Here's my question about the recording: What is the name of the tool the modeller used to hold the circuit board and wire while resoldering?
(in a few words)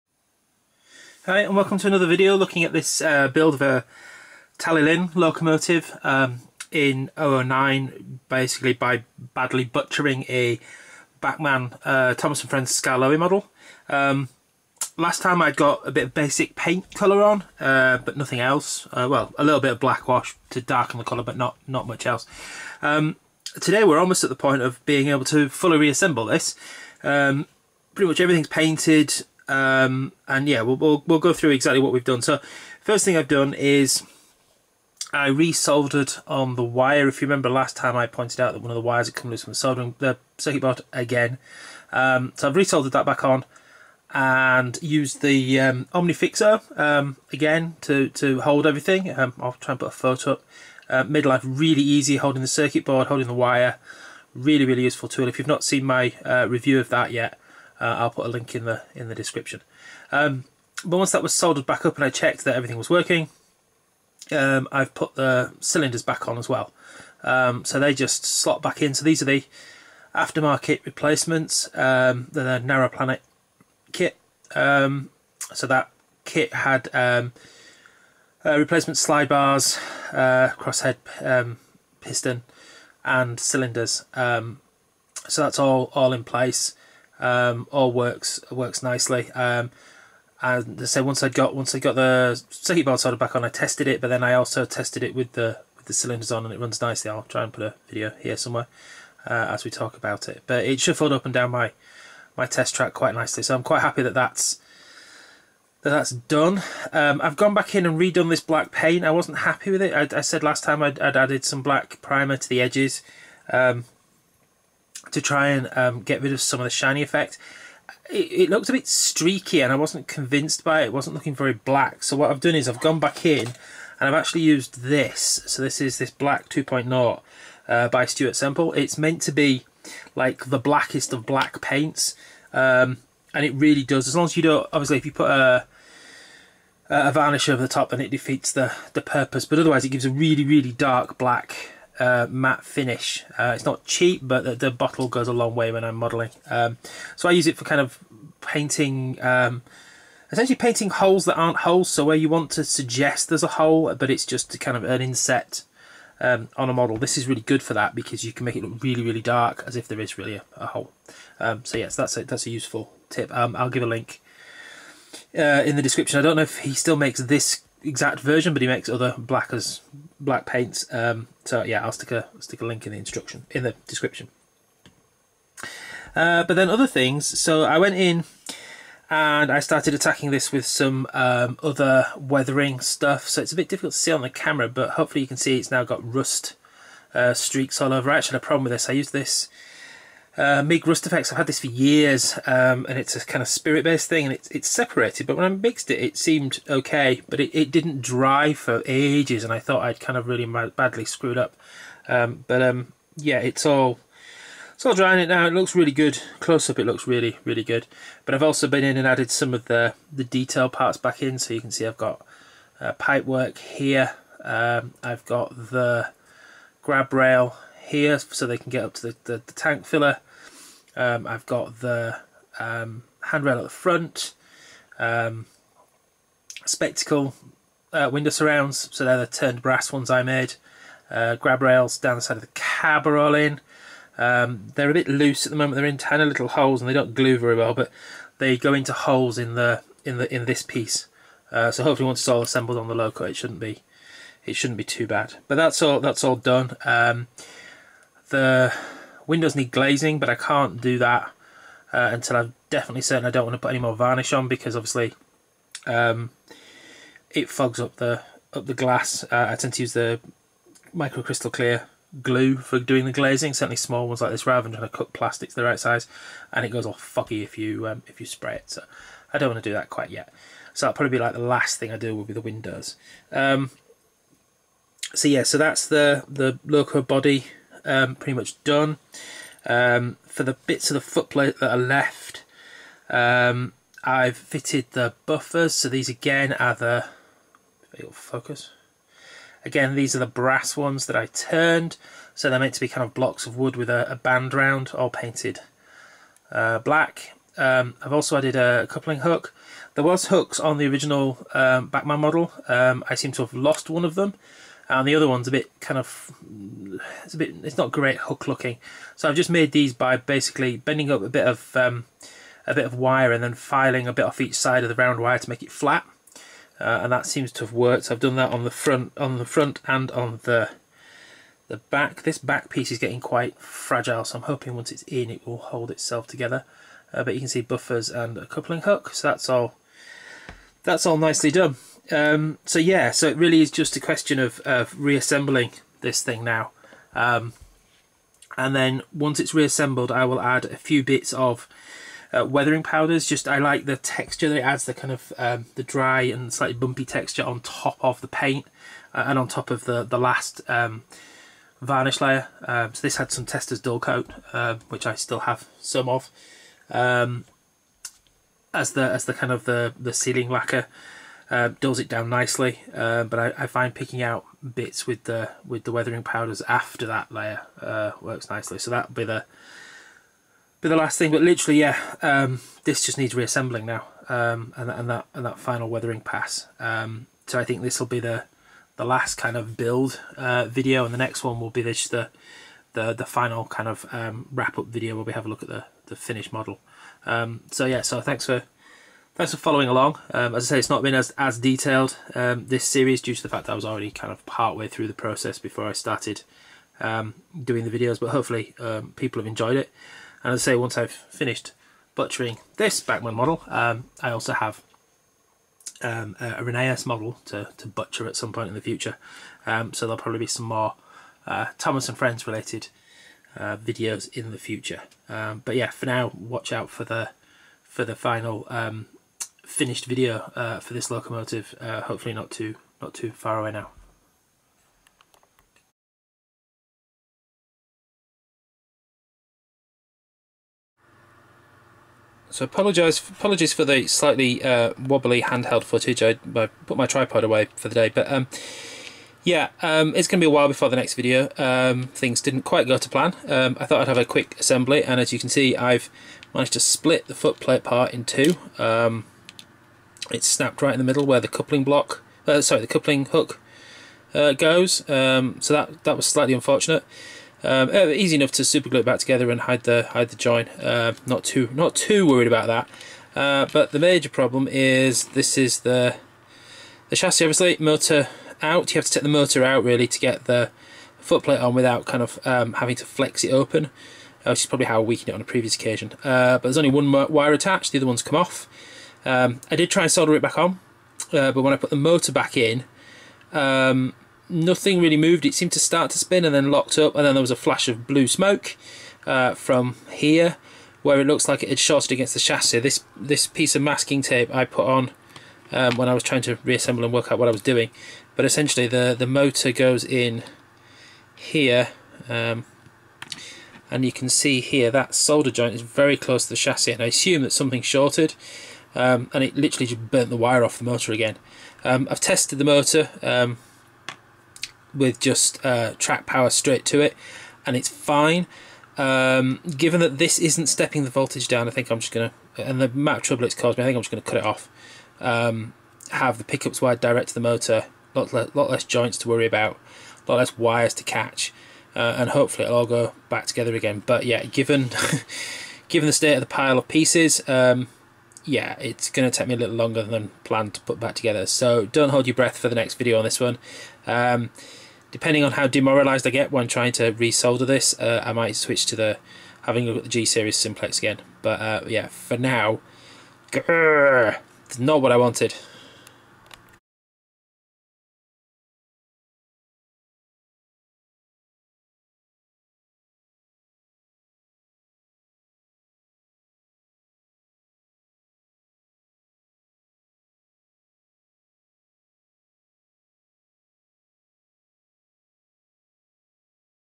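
OMNIFIXO.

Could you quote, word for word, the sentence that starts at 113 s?
Um, to try and um, get rid of some of the shiny effect.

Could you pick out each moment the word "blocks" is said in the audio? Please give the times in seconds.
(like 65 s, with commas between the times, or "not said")
293 s, 451 s.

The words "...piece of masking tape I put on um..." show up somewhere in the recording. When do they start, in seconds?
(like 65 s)
493 s.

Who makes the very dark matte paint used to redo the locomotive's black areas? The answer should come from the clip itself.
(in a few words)
Stuart Semple.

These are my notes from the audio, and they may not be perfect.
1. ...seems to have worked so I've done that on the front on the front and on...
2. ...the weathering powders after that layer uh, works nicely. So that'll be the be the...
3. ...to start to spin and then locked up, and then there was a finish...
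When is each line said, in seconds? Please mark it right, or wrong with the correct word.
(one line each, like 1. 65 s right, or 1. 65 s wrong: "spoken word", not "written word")
1. 317 s right
2. 365 s right
3. 485 s wrong: "flash", not "finish".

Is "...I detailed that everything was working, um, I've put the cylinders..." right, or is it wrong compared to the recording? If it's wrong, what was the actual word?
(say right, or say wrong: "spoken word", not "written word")
wrong: "checked", not "detailed".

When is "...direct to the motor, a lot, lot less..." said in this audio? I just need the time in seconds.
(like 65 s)
526 s.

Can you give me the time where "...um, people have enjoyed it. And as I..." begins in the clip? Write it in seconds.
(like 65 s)
398 s.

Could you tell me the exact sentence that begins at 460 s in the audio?
Uh, not too not too worried about that.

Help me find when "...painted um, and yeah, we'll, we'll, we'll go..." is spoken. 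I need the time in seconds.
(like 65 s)
28 s.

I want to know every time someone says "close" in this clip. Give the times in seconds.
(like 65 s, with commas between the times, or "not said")
206 s, 506 s.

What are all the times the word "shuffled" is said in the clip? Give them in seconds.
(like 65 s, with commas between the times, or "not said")
100 s.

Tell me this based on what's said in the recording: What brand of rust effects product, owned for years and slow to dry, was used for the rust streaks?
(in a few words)
Mig.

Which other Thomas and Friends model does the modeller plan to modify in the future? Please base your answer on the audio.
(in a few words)
Rheneas.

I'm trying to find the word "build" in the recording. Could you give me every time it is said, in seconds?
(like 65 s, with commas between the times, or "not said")
3 s, 379 s.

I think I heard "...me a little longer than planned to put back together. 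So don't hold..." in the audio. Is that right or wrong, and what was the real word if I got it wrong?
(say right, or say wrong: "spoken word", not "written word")
right.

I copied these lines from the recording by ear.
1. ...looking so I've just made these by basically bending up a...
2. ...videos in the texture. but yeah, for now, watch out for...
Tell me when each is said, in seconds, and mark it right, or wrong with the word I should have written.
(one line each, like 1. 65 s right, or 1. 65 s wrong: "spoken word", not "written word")
1. 308 s right
2. 413 s wrong: "future", not "texture".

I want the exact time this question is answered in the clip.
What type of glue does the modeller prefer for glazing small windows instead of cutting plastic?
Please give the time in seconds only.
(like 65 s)
260 s.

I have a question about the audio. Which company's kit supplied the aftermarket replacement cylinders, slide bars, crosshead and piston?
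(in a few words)
Narrow Planet.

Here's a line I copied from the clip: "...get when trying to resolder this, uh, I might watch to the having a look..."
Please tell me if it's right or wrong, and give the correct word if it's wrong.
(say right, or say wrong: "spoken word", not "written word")
wrong: "switch", not "watch".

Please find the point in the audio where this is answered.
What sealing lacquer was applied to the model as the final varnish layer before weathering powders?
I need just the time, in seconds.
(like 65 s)
353 s.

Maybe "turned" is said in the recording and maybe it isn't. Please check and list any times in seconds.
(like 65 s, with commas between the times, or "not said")
229 s, 291 s.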